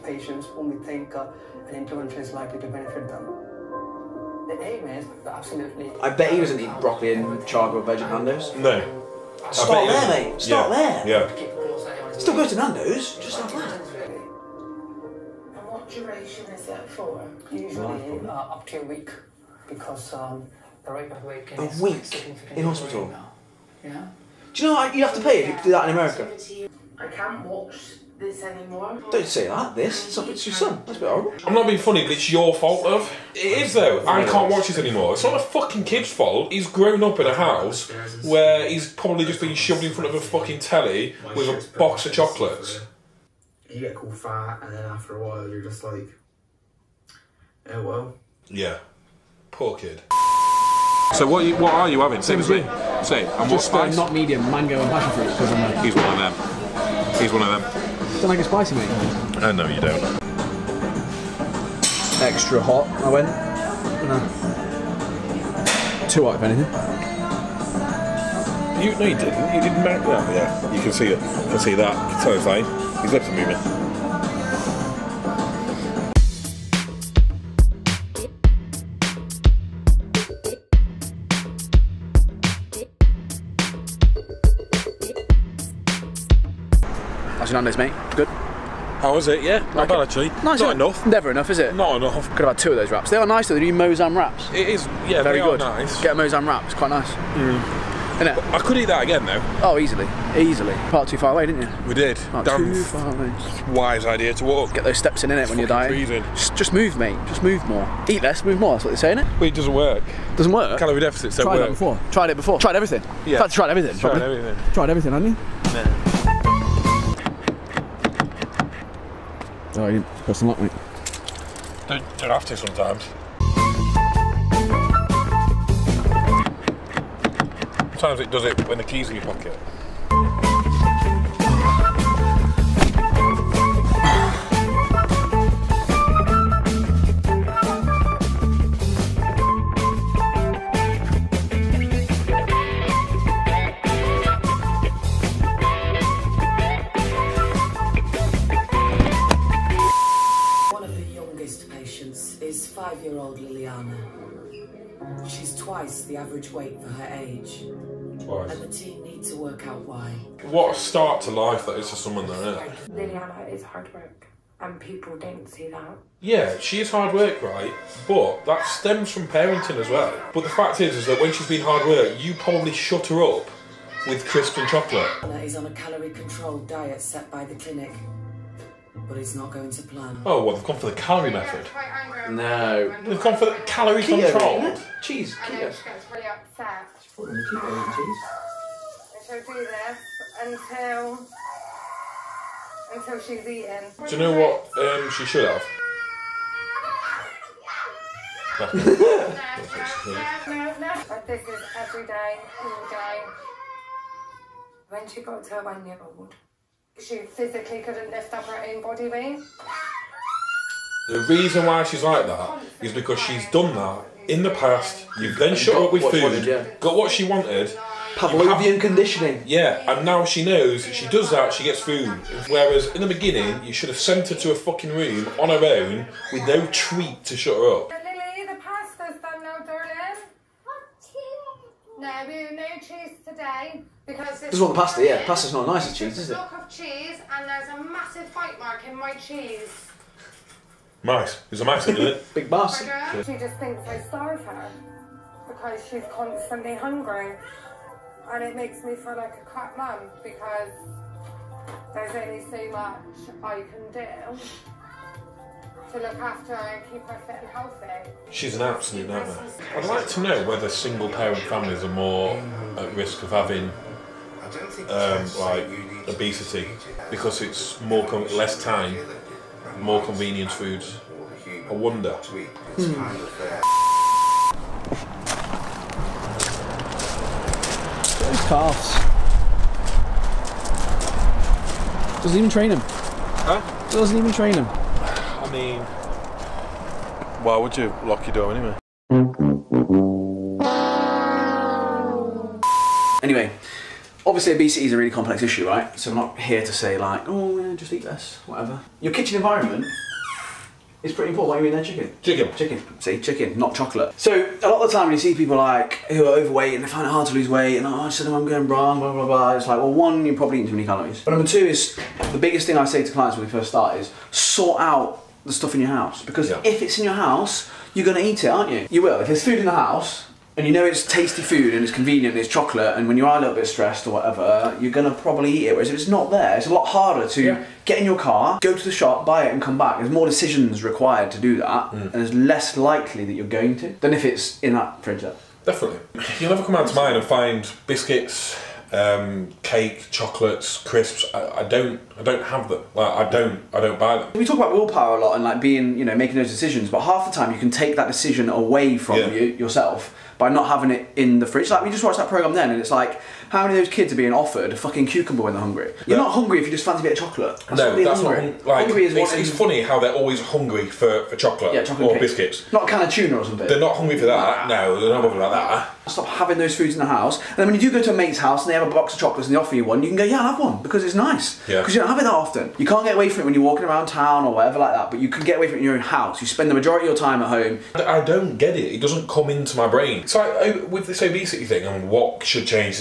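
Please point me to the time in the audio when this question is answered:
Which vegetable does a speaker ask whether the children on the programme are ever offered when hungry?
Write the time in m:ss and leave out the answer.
5:55.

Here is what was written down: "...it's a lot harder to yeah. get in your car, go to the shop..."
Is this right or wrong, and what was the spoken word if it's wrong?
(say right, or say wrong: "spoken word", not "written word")
right.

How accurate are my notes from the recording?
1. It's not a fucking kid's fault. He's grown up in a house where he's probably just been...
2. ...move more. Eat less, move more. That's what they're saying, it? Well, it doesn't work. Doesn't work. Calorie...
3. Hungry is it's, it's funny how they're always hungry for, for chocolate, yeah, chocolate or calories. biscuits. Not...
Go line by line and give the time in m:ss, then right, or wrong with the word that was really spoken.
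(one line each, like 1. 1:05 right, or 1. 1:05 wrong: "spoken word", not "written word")
1. 0:35 right
2. 1:47 right
3. 5:58 wrong: "cakes", not "calories".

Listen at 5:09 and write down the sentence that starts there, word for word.
It's like well, one, you're probably eating too many calories.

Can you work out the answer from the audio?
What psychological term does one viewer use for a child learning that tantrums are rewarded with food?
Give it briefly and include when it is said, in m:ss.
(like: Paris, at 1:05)
Pavlovian conditioning, at 3:38.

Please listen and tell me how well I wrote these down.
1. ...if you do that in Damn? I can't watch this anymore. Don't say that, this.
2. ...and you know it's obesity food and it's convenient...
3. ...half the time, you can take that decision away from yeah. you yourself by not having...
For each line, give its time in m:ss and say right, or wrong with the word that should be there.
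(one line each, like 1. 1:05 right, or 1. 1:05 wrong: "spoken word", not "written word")
1. 0:25 wrong: "America", not "Damn"
2. 5:20 wrong: "tasty", not "obesity"
3. 5:47 right.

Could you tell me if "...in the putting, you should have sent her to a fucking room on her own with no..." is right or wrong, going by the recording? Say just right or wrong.
wrong.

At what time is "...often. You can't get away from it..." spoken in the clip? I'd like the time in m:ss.
6:12.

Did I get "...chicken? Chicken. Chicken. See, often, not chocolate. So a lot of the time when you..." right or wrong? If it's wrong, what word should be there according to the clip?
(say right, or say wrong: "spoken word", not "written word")
wrong: "chicken", not "often".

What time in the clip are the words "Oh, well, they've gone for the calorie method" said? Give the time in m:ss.
3:00.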